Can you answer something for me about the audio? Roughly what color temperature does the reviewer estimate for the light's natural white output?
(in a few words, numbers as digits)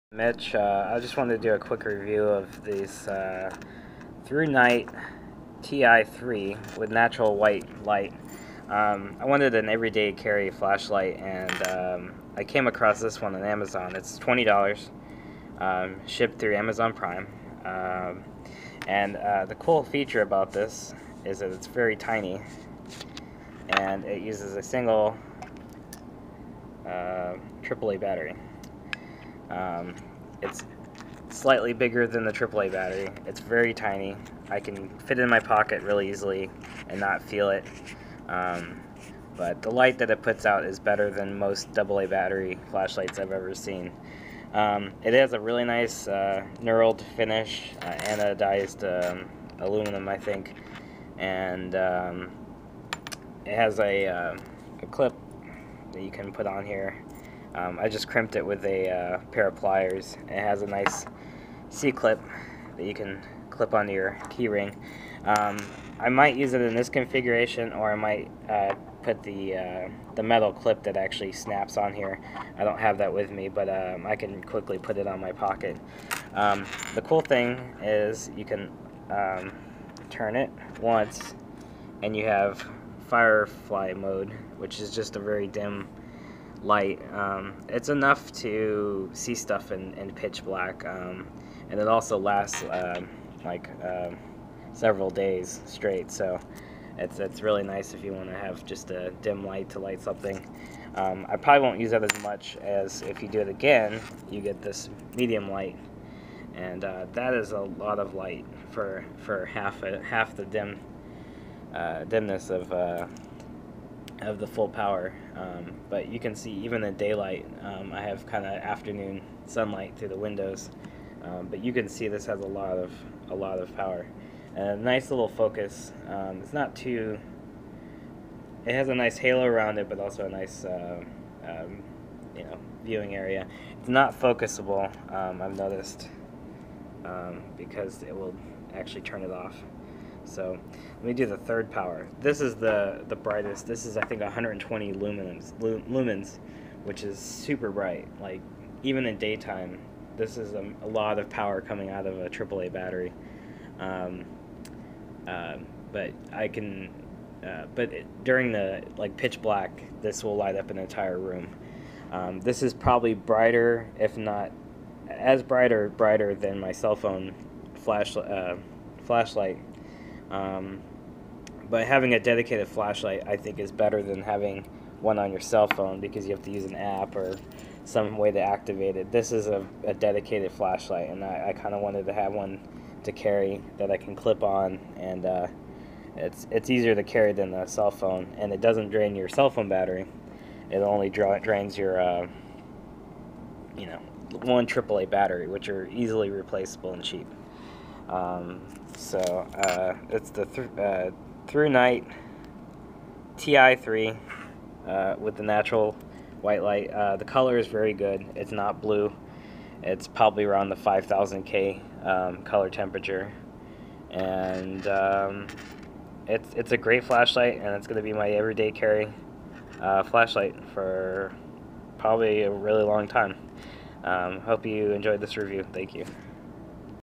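5000K.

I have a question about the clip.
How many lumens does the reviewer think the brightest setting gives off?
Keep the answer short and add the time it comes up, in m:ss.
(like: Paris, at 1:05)
120, at 2:24.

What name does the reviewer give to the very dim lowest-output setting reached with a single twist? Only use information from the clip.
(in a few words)
firefly mode.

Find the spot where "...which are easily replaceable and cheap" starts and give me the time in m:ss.
3:15.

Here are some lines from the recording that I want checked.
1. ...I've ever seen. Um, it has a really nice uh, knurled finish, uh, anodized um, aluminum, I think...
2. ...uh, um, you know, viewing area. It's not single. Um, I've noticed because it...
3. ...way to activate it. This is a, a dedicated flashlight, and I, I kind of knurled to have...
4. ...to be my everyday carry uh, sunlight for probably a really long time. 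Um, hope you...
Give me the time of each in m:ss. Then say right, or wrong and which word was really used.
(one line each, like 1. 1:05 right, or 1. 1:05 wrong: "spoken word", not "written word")
1. 0:43 right
2. 2:10 wrong: "focusable", not "single"
3. 2:58 wrong: "wanted", not "knurled"
4. 3:37 wrong: "flashlight", not "sunlight".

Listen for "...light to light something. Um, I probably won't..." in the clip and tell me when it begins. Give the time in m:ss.
1:39.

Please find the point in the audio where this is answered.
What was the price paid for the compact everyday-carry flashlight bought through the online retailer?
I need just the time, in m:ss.
0:14.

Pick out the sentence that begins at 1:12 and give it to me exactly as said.
I don't have that with me, but um, I can quickly put it on my pocket.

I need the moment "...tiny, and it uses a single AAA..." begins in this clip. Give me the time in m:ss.
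0:21.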